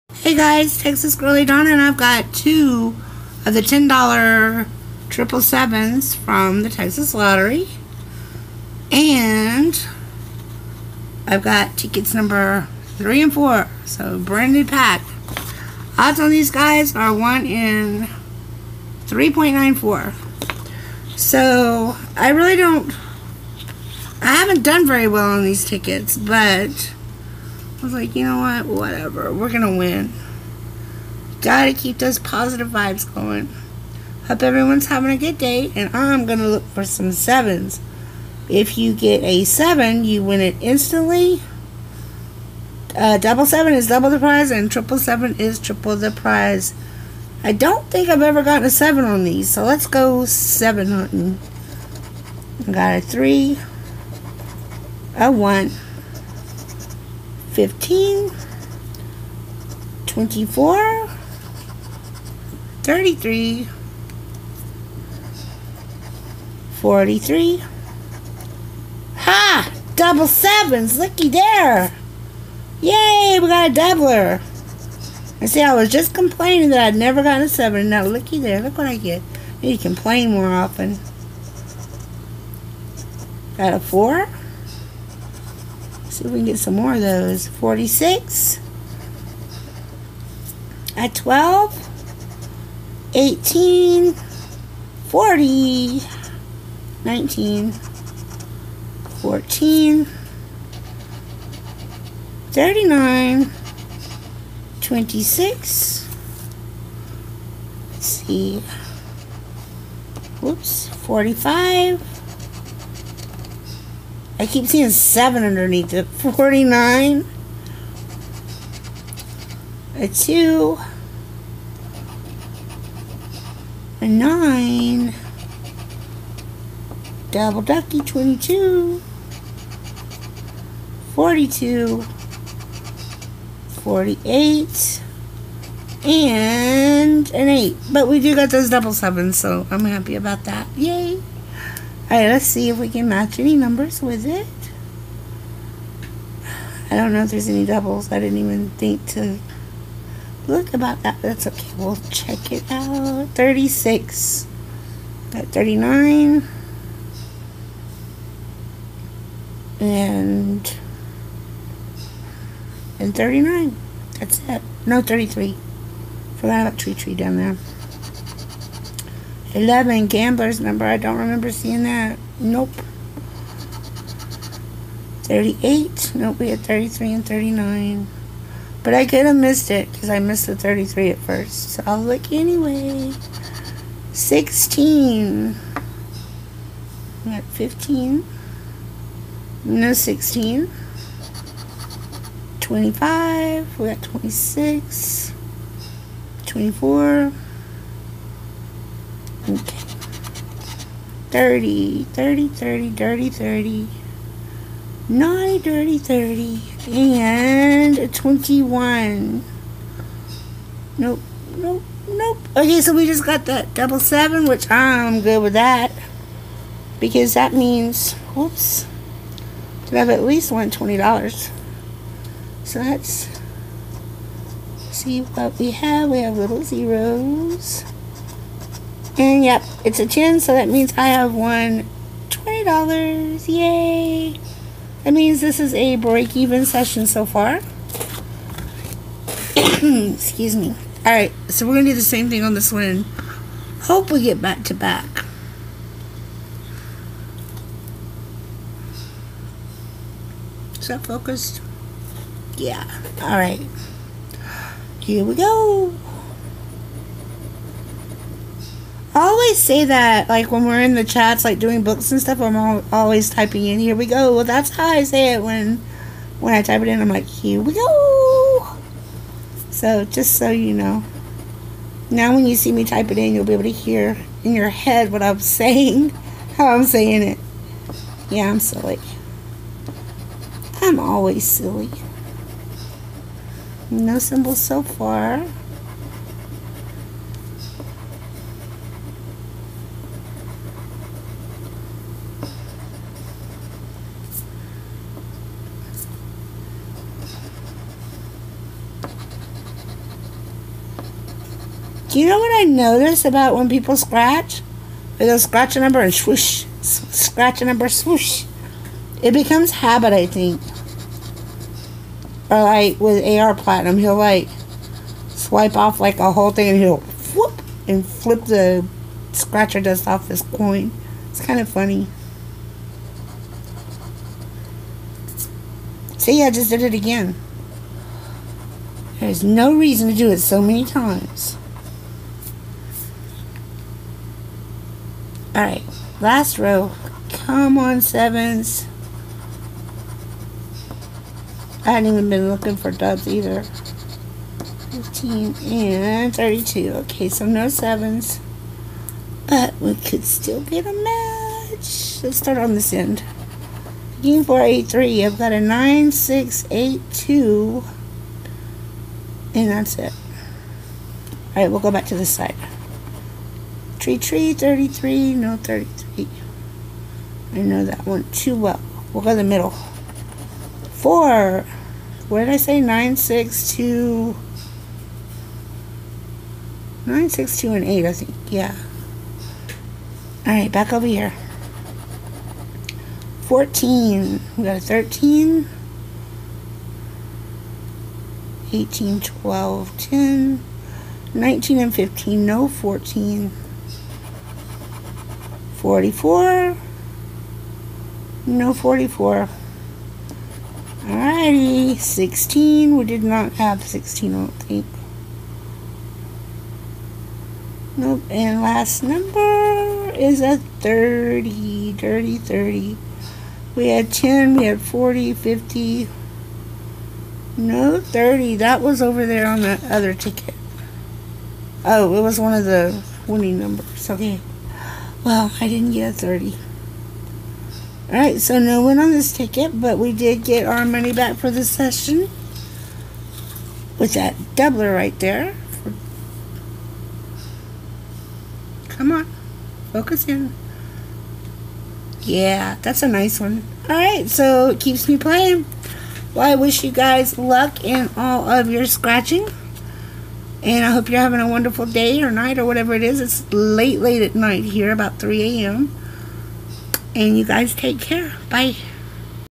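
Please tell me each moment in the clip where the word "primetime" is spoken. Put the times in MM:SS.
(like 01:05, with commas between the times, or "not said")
not said.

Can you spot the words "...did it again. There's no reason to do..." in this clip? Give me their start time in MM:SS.
05:26.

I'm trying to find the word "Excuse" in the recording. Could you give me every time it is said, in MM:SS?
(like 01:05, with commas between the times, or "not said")
03:59.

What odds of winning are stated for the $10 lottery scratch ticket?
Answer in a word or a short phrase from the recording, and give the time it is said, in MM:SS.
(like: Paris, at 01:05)
1 in 3.94, at 00:17.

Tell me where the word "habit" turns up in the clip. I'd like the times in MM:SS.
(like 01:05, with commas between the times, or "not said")
05:09.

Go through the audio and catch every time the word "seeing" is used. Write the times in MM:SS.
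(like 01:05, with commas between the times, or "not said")
01:54, 02:51.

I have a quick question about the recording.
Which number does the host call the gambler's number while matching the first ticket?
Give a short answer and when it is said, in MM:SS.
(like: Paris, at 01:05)
11, at 02:49.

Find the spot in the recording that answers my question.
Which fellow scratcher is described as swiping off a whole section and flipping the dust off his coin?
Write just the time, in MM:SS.
05:13.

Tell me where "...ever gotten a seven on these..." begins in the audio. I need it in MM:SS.
00:48.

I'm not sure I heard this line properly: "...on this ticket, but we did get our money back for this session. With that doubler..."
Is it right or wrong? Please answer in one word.
right.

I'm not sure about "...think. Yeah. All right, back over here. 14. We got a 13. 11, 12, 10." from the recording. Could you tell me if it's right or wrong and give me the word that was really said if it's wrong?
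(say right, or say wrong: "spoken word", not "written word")
wrong: "18", not "11".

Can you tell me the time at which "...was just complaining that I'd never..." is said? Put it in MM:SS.
01:15.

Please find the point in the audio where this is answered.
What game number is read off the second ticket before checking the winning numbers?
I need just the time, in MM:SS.
05:54.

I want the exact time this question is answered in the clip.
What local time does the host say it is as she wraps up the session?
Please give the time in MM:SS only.
07:34.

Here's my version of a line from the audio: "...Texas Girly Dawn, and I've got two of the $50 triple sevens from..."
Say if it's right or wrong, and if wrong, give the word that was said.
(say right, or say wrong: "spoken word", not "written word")
wrong: "10", not "50".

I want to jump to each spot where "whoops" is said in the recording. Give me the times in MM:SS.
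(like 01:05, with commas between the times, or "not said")
03:38, 05:17.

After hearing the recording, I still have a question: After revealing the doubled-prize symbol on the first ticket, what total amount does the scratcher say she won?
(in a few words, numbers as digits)
$20.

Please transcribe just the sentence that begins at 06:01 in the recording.
Alright, we'll go back to this side.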